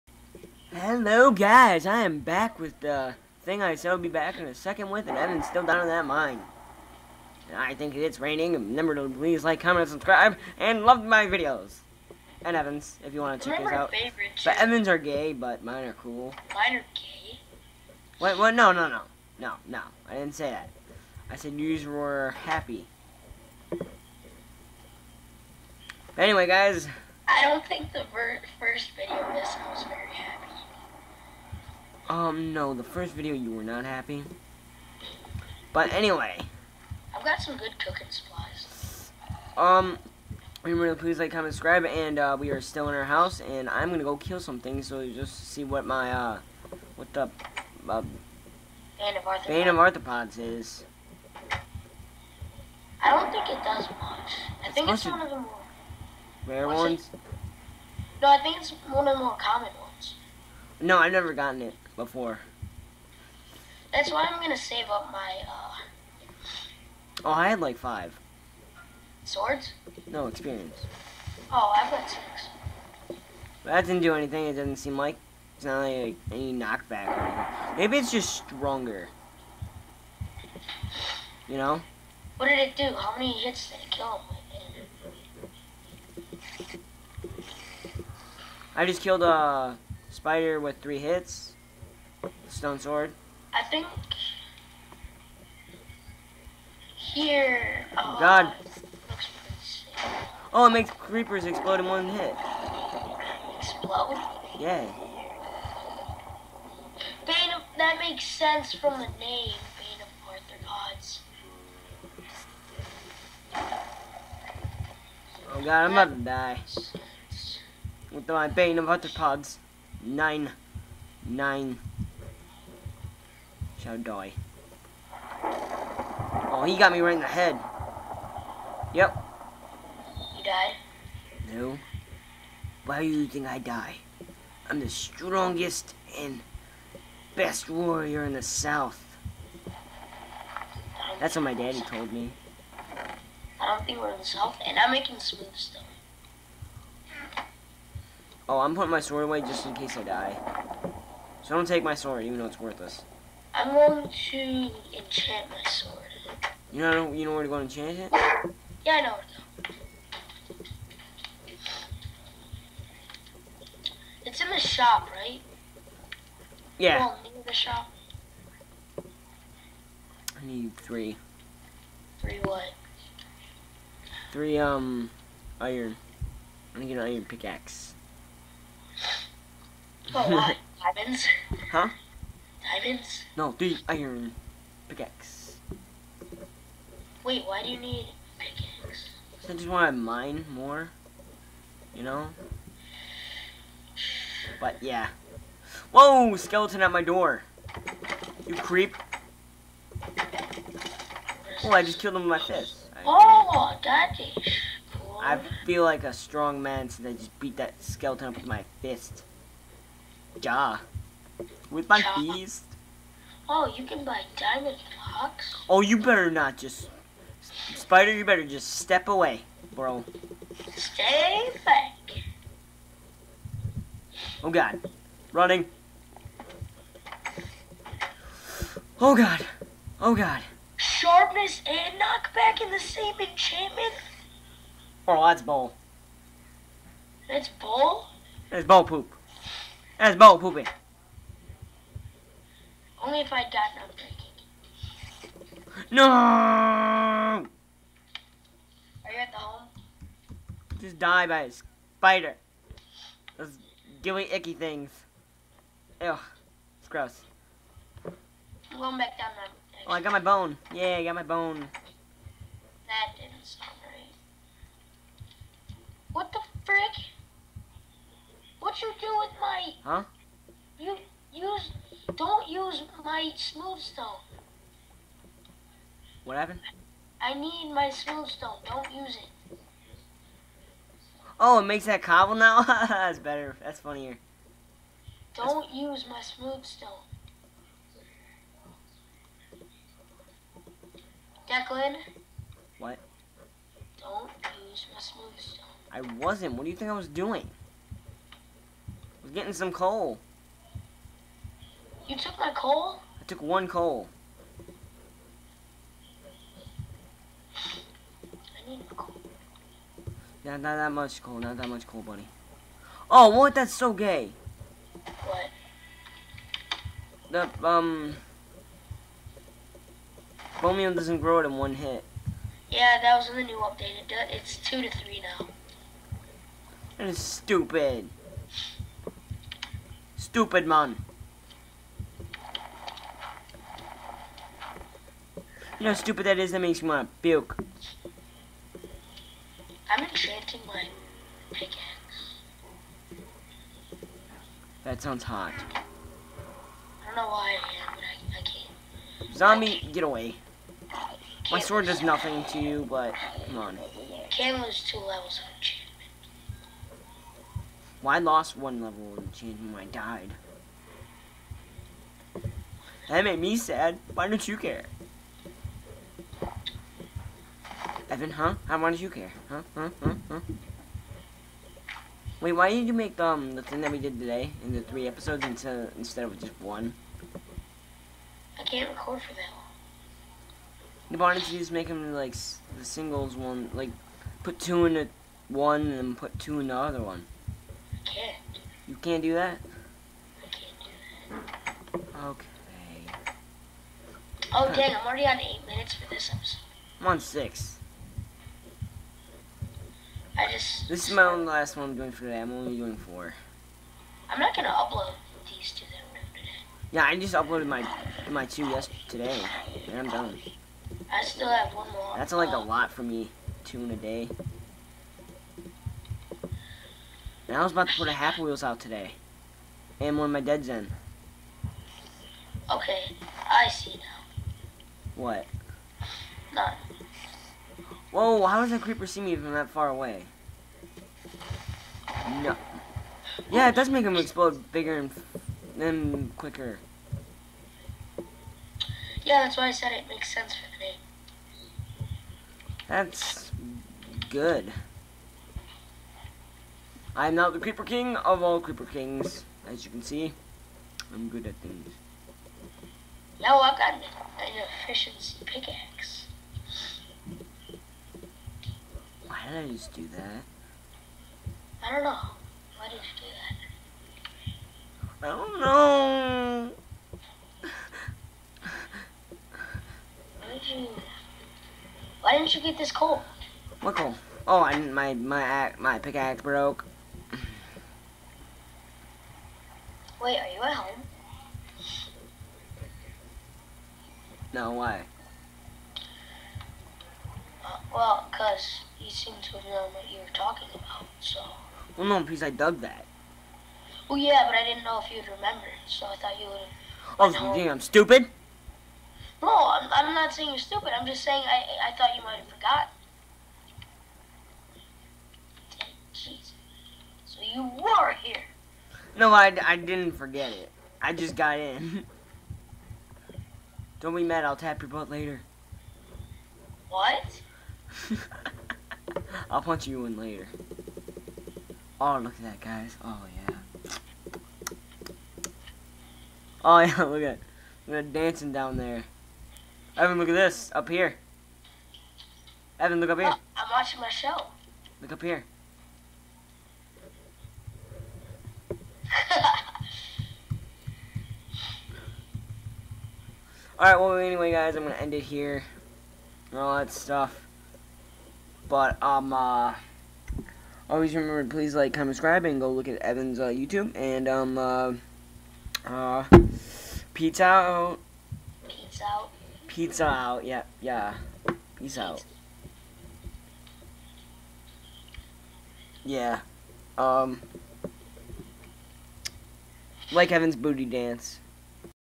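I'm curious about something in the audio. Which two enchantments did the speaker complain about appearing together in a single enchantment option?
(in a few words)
Sharpness and knockback.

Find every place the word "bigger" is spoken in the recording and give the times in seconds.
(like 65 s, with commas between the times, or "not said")
434 s.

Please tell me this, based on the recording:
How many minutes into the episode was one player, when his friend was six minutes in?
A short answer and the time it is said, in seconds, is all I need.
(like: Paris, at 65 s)
8, at 395 s.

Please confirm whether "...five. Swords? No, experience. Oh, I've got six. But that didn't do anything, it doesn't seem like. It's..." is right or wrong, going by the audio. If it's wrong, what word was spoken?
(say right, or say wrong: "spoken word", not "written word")
right.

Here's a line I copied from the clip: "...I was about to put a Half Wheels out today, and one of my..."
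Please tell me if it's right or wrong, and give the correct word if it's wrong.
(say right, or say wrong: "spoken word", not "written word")
right.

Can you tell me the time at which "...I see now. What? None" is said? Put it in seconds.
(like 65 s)
423 s.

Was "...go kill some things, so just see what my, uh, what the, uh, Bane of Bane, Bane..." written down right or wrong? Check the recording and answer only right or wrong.
wrong.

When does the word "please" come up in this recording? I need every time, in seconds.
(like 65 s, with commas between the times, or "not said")
9 s, 41 s, 551 s.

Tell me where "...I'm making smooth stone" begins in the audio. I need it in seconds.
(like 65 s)
144 s.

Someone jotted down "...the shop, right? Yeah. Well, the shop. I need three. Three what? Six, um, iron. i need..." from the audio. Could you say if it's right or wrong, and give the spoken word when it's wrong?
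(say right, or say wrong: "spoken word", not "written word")
wrong: "Three", not "Six".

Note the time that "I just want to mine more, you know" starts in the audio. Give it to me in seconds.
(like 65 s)
189 s.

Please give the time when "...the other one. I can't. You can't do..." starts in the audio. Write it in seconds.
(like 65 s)
386 s.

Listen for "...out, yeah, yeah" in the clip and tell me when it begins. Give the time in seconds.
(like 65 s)
560 s.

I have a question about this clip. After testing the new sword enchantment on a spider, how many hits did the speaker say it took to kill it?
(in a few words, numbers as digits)
3.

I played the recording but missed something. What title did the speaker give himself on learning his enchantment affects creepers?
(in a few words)
Creeper King.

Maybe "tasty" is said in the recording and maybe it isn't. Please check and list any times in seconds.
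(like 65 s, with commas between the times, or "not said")
not said.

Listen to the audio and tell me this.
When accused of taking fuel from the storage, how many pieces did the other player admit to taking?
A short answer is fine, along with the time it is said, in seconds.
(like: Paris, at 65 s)
1, at 303 s.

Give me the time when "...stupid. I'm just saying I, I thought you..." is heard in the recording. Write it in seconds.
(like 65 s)
500 s.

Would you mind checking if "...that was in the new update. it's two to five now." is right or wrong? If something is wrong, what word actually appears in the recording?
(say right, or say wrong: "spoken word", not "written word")
wrong: "three", not "five".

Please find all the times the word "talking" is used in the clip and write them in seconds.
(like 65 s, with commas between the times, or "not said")
490 s.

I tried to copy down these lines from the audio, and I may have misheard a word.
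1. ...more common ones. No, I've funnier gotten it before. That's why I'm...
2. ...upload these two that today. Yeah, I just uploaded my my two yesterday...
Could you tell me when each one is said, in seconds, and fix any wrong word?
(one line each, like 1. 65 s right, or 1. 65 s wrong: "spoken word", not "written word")
1. 59 s wrong: "never", not "funnier"
2. 404 s right.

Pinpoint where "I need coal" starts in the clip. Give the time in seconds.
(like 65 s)
308 s.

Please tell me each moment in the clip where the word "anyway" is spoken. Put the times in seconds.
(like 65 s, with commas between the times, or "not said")
26 s, 35 s, 544 s.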